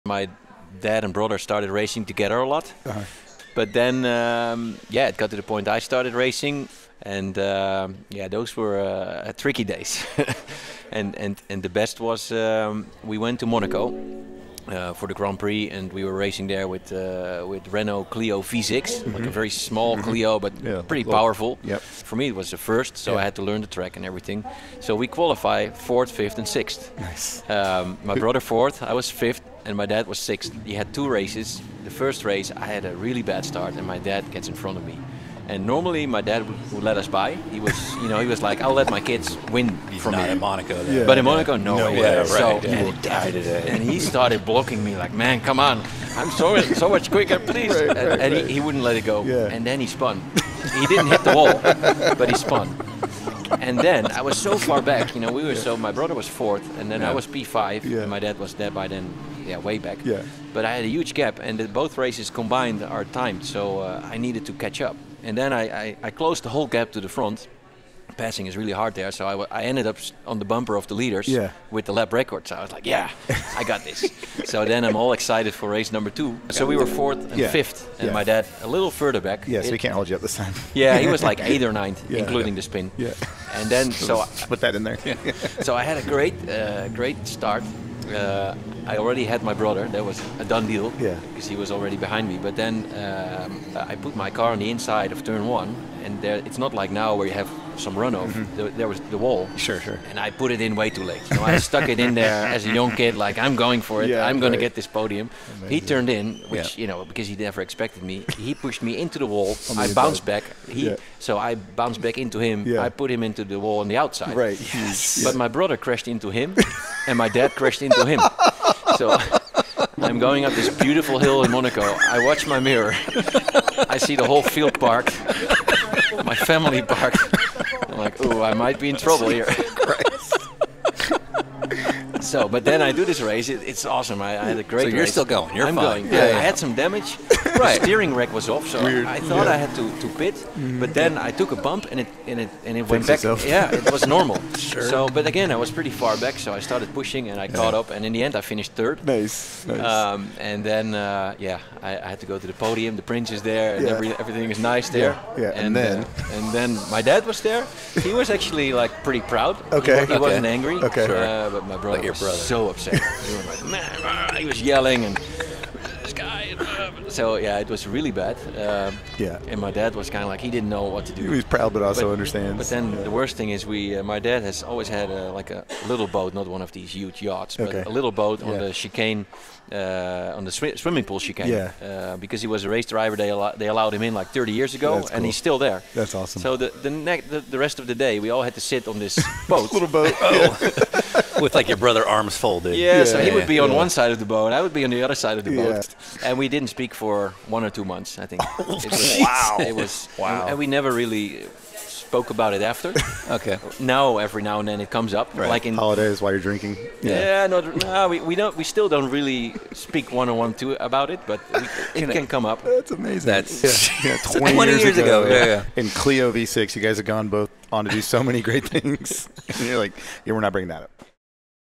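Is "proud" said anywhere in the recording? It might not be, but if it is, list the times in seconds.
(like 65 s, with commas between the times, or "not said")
159 s, 171 s.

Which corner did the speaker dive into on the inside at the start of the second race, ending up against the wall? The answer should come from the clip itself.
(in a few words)
Turn 1.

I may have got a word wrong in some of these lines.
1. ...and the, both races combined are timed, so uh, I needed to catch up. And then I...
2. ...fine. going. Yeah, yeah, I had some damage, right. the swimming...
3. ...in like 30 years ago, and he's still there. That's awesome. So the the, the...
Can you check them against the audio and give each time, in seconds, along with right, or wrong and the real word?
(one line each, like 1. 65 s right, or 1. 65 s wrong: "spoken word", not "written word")
1. 61 s right
2. 135 s wrong: "steering", not "swimming"
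3. 184 s right.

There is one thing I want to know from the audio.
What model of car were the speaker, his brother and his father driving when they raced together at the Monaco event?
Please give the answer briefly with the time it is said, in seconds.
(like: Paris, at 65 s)
Renault Clio V6, at 17 s.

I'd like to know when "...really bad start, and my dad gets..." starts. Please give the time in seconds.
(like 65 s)
33 s.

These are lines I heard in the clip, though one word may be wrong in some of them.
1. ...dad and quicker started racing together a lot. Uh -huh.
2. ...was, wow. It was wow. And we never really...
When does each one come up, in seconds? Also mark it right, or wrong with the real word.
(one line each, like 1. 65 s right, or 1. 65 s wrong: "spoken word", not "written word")
1. 0 s wrong: "brother", not "quicker"
2. 199 s right.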